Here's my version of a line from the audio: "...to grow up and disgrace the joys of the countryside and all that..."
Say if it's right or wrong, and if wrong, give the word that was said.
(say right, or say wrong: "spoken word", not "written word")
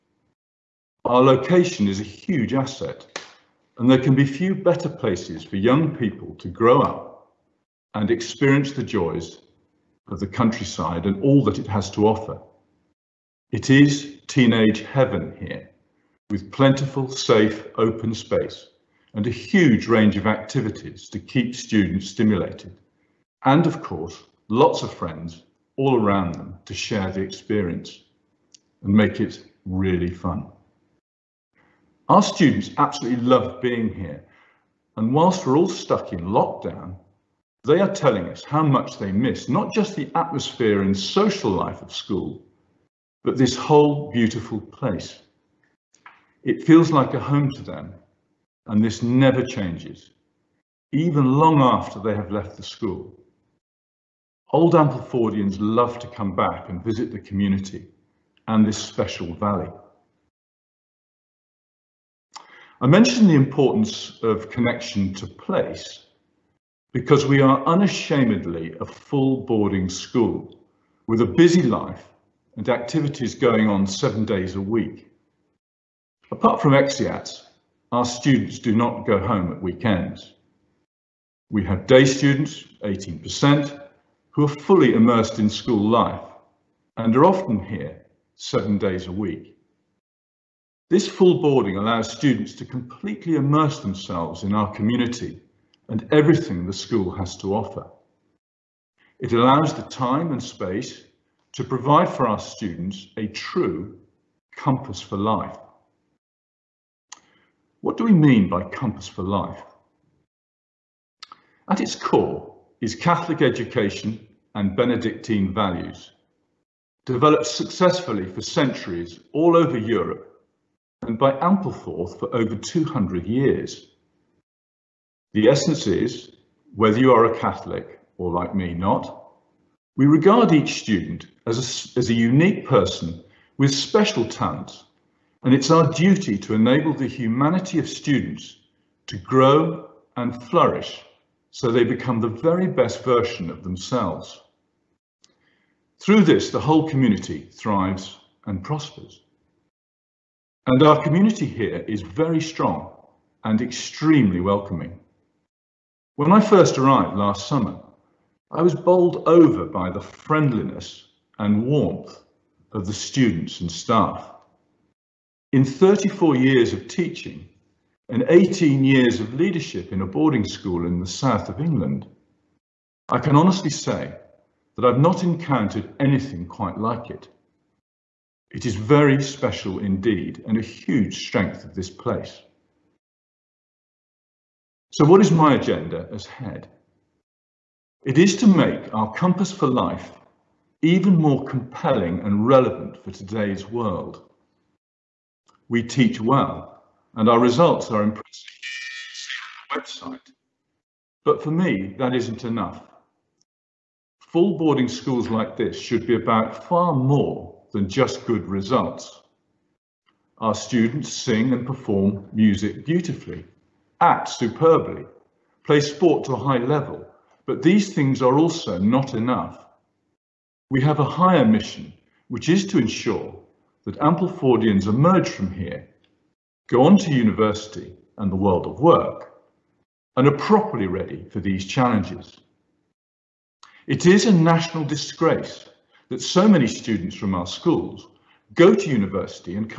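wrong: "experience", not "disgrace".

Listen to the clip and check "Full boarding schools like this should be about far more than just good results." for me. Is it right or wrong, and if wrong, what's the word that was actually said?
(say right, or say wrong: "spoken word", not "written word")
right.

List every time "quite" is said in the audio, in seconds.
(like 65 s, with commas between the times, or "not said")
176 s.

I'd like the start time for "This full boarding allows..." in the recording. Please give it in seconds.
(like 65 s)
90 s.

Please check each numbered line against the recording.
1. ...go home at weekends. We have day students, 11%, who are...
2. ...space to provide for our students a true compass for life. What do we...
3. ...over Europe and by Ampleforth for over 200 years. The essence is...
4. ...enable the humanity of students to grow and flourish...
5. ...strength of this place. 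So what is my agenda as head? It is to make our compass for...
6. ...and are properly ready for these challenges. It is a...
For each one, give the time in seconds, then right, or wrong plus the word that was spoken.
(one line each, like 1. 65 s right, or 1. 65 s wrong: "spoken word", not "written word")
1. 79 s wrong: "18", not "11"
2. 100 s right
3. 119 s right
4. 136 s right
5. 181 s right
6. 230 s right.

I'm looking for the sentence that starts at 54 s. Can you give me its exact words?
Old Amplefordians love to come back and visit the community and this special valley.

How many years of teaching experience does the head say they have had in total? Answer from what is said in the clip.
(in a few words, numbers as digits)
34.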